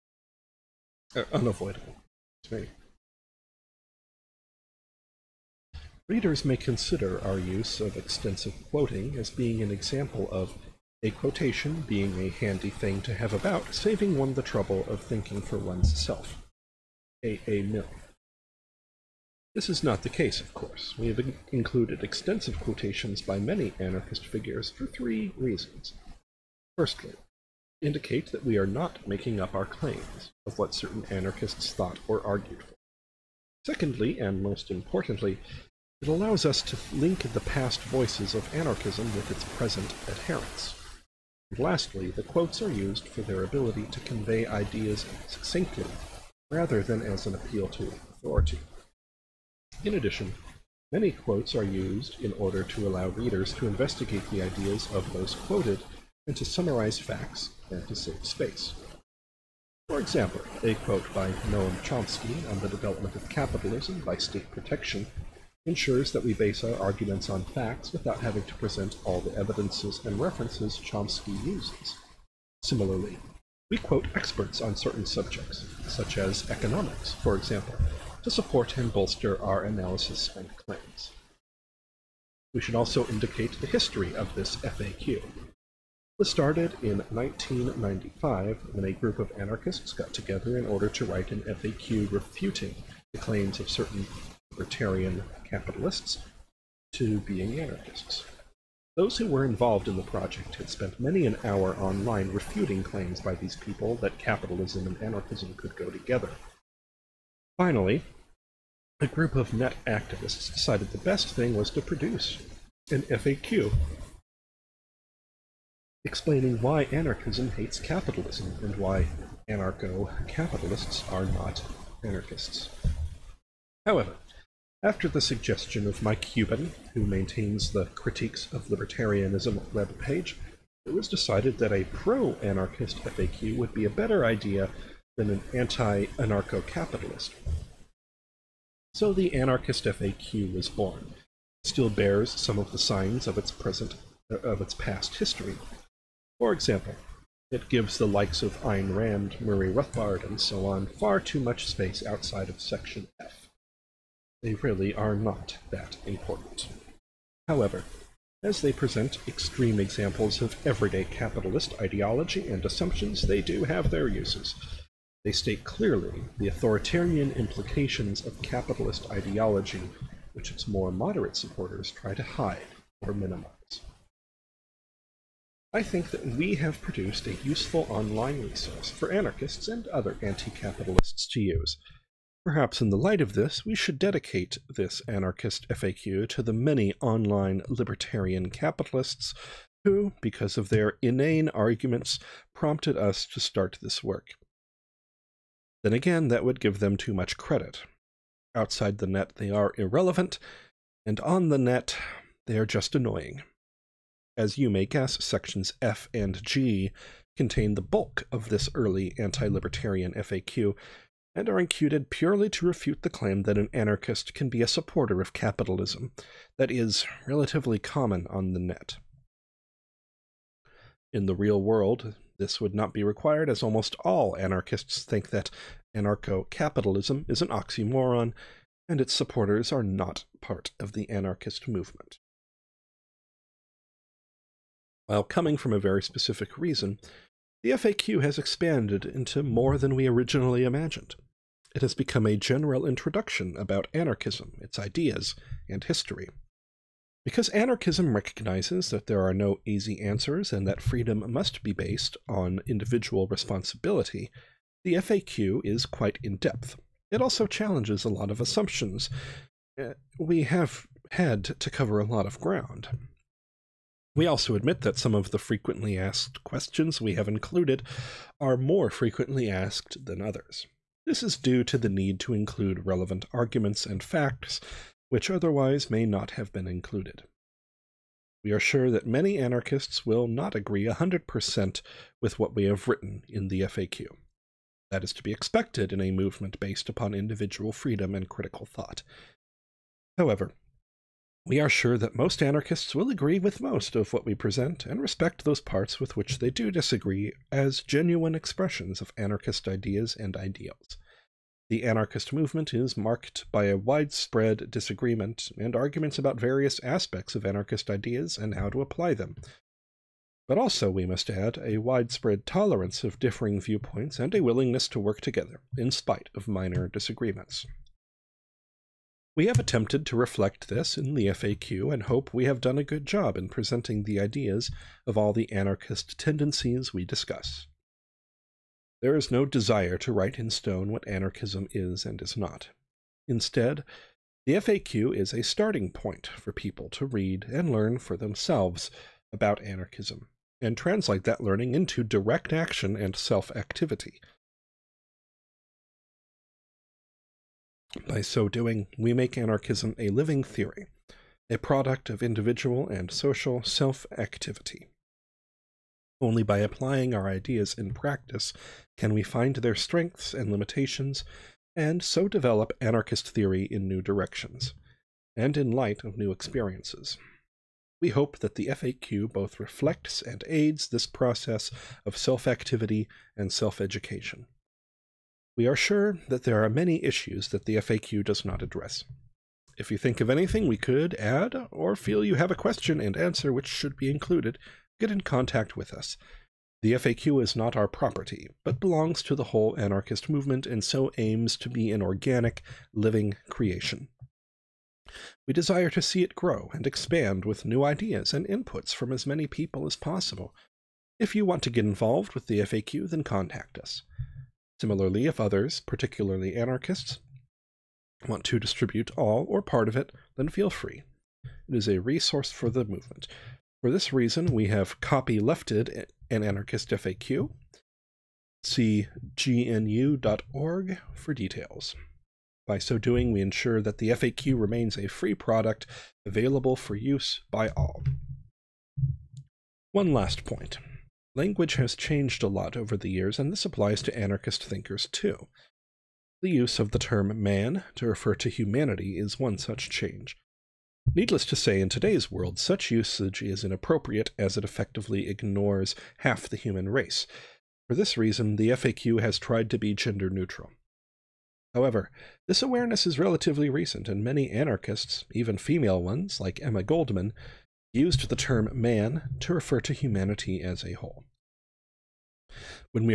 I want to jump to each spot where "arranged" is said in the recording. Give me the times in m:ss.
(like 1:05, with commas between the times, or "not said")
not said.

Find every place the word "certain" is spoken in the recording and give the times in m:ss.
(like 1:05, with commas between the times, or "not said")
0:30, 1:14, 1:33.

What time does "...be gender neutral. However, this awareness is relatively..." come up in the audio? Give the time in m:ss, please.
7:29.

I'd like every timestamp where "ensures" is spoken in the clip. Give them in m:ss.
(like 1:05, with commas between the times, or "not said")
1:05, 7:03.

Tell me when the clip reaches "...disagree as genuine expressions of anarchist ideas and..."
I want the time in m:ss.
4:56.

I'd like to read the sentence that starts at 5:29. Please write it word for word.
There is no desire to write in stone what anarchism is and is not.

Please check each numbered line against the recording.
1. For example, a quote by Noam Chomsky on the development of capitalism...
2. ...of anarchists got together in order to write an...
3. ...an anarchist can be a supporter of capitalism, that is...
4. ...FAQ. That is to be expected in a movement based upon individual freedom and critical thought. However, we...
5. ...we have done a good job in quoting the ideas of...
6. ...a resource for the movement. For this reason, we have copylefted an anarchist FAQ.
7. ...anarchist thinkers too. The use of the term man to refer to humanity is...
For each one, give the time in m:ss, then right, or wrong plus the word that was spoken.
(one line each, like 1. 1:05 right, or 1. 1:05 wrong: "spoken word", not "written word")
1. 0:59 right
2. 1:29 right
3. 3:33 right
4. 4:43 right
5. 5:22 wrong: "presenting", not "quoting"
6. 6:51 right
7. 7:14 right.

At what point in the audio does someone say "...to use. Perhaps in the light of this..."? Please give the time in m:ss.
3:01.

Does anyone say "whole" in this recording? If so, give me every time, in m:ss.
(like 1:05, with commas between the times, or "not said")
6:29, 7:40.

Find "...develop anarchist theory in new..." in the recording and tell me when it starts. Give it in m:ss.
6:02.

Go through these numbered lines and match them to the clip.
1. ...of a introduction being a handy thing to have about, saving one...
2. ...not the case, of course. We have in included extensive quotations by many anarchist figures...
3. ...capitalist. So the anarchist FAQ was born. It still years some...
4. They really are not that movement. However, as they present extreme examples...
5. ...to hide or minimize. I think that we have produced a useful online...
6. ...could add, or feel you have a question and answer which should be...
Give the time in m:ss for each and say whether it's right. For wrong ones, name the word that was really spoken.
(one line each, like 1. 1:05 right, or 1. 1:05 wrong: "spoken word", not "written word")
1. 0:10 wrong: "quotation", not "introduction"
2. 0:19 right
3. 2:16 wrong: "bears", not "years"
4. 2:34 wrong: "important", not "movement"
5. 2:52 right
6. 6:20 right.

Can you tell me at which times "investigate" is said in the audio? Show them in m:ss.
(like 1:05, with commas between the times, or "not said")
0:53.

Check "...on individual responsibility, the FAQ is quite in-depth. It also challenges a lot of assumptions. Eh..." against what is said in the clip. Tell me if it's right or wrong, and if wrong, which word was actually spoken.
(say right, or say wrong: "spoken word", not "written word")
right.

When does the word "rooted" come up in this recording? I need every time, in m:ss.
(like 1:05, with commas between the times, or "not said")
not said.